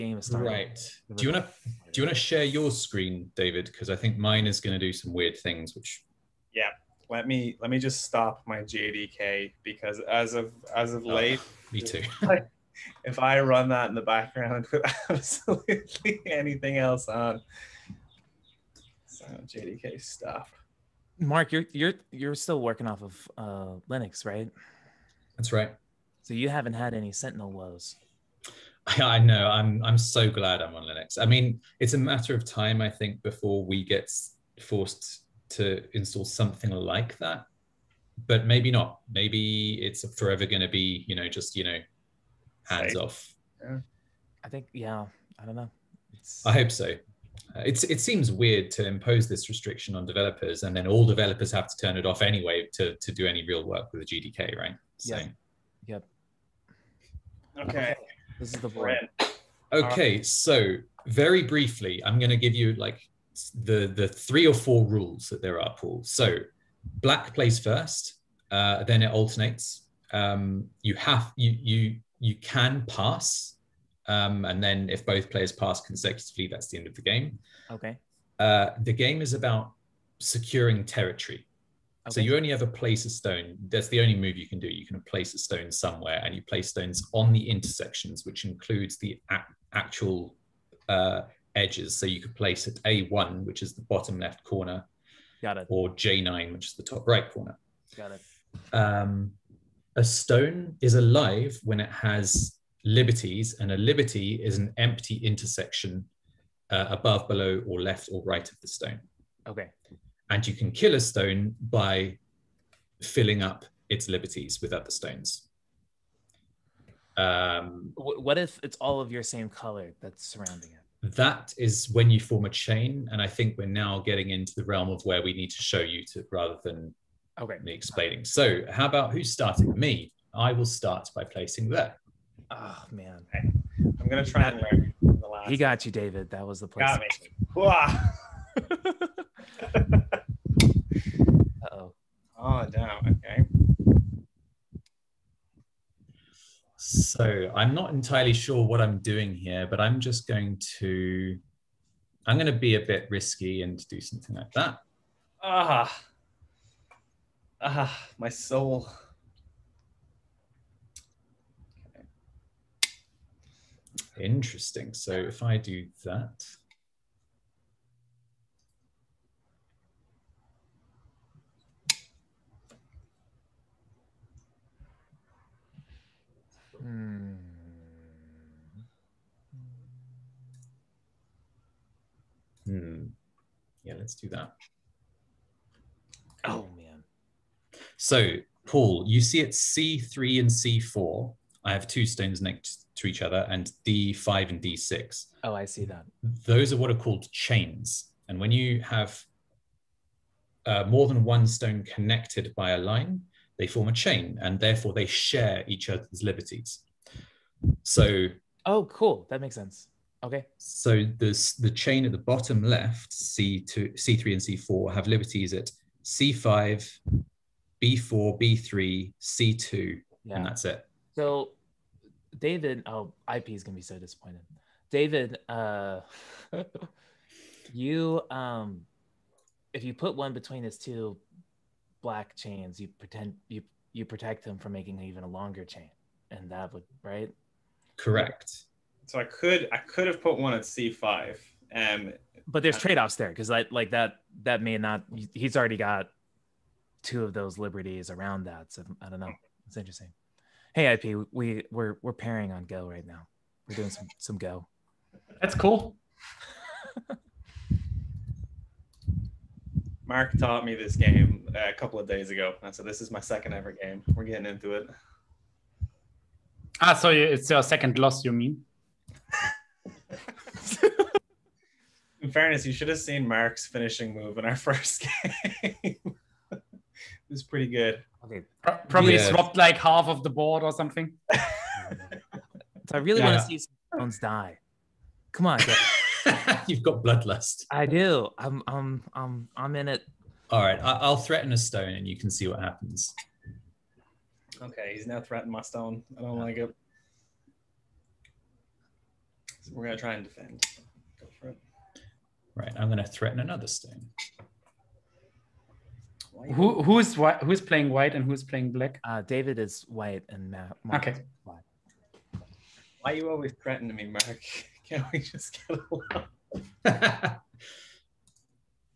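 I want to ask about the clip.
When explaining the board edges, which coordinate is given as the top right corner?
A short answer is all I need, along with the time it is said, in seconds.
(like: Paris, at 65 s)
J9, at 95 s.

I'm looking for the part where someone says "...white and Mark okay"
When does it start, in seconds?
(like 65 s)
309 s.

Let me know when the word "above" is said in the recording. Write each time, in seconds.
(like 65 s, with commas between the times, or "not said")
106 s.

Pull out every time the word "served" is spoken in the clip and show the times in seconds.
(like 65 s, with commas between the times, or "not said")
not said.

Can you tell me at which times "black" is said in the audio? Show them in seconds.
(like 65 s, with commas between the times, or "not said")
67 s, 232 s, 308 s.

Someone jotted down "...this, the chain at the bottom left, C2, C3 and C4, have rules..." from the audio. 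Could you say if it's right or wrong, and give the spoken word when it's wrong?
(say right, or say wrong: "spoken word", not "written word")
wrong: "liberties", not "rules".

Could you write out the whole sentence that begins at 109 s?
Okay and you can kill a stone by filling up its liberties with other stones.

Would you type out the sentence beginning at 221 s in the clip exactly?
So, David, oh, IP is going to be so disappointed.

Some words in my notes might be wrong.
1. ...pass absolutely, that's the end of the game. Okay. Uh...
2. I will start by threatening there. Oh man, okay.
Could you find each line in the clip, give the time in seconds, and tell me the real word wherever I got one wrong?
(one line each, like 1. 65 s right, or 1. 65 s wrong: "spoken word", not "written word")
1. 75 s wrong: "consecutively", not "absolutely"
2. 130 s wrong: "placing", not "threatening".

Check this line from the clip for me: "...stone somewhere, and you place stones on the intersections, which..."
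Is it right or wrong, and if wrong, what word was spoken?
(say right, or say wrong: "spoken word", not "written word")
right.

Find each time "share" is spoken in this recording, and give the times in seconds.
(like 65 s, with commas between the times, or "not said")
2 s, 205 s.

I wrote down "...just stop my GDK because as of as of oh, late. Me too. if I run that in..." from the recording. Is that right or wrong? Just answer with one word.
right.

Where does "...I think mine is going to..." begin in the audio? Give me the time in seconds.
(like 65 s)
3 s.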